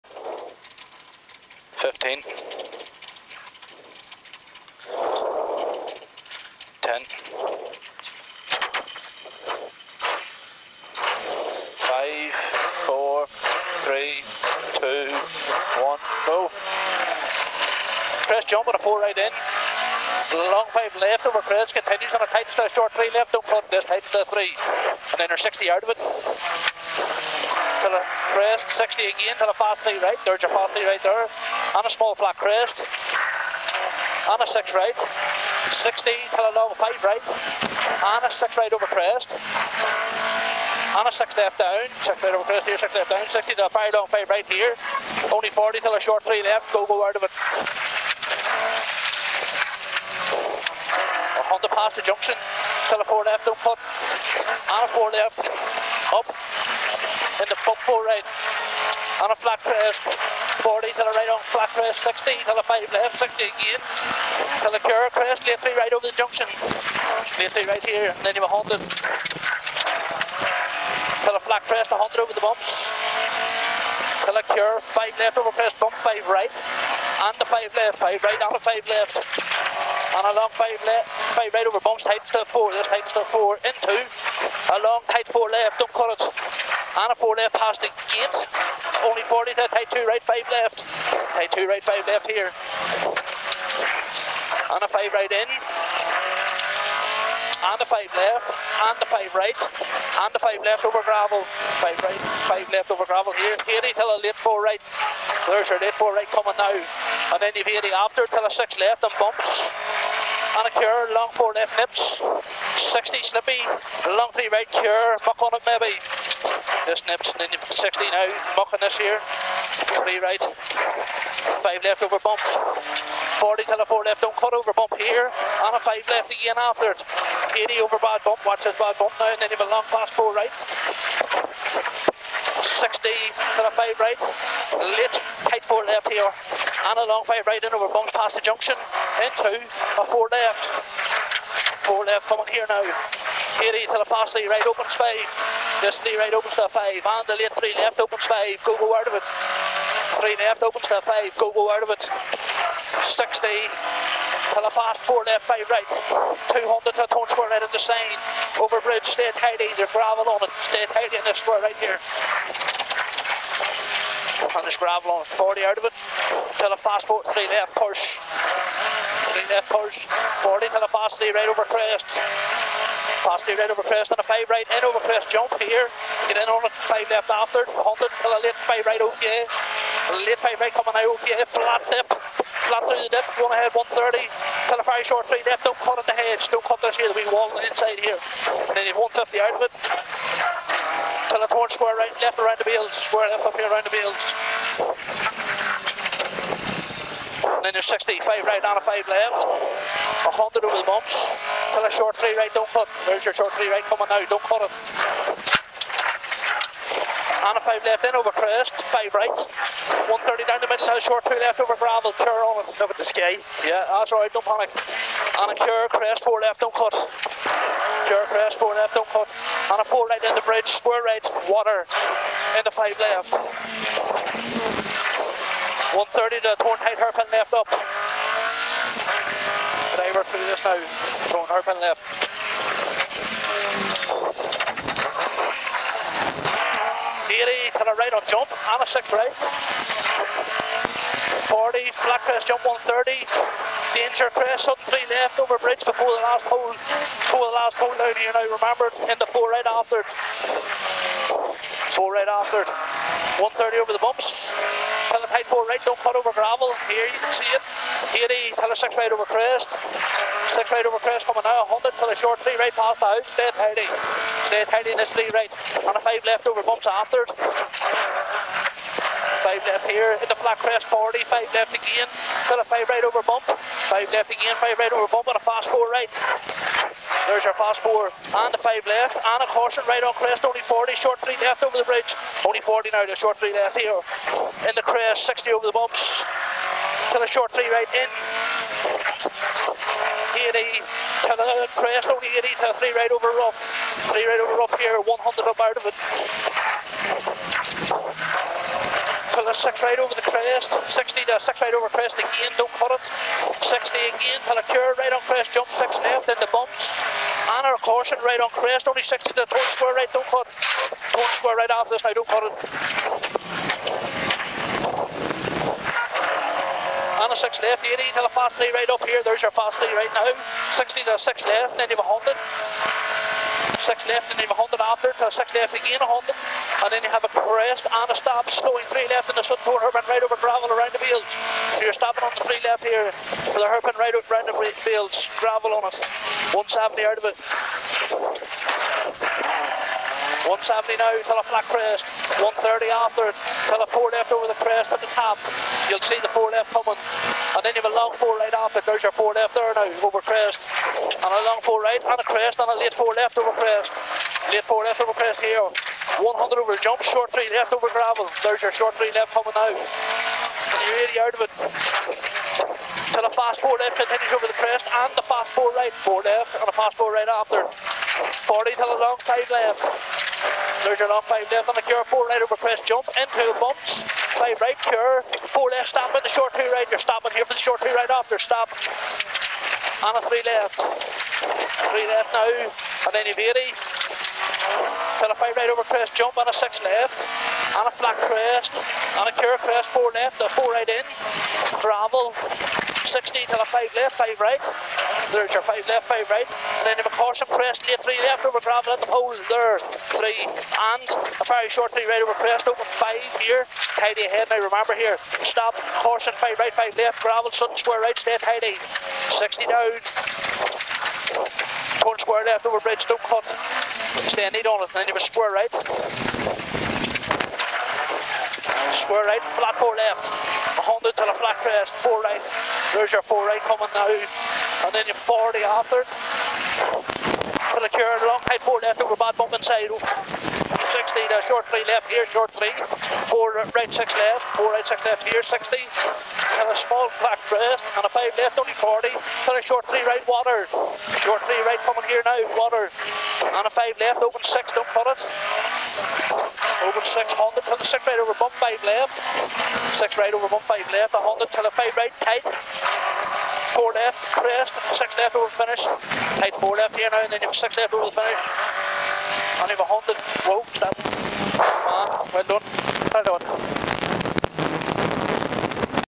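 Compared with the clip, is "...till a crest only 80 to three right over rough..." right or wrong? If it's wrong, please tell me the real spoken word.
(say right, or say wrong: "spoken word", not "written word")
right.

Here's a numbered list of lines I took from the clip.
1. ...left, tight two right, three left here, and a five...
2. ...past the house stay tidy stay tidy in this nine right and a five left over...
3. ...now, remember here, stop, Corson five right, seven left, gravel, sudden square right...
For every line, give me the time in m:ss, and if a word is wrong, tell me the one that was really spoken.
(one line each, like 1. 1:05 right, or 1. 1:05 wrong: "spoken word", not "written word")
1. 1:30 wrong: "five", not "three"
2. 4:22 wrong: "three", not "nine"
3. 6:44 wrong: "five", not "seven".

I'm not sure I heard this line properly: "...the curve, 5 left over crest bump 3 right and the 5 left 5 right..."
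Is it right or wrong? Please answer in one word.
wrong.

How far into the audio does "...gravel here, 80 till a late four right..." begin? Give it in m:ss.
1:43.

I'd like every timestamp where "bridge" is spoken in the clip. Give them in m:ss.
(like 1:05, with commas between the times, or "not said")
2:38, 3:40, 4:05, 4:41, 6:52.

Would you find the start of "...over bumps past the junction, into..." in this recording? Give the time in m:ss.
2:17.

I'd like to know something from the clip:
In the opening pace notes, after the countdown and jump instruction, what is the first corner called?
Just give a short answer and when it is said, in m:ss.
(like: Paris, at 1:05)
4 right, at 0:18.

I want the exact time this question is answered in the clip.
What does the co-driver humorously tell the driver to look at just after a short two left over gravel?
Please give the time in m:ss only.
3:32.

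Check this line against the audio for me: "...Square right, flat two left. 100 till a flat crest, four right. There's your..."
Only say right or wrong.
wrong.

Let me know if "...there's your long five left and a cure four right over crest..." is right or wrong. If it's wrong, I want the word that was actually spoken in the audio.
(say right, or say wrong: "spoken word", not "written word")
right.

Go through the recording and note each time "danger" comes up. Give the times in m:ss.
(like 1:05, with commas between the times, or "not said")
4:03.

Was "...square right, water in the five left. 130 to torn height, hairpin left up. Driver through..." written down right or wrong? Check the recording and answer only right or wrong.
right.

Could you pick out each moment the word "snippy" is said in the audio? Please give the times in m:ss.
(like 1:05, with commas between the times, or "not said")
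1:53.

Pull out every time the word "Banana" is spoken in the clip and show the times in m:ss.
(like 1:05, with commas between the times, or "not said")
1:50.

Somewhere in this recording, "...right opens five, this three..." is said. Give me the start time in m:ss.
2:24.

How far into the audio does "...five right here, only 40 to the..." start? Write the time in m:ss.
0:44.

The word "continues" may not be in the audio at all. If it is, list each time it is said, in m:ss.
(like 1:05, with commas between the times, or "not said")
0:21, 6:03.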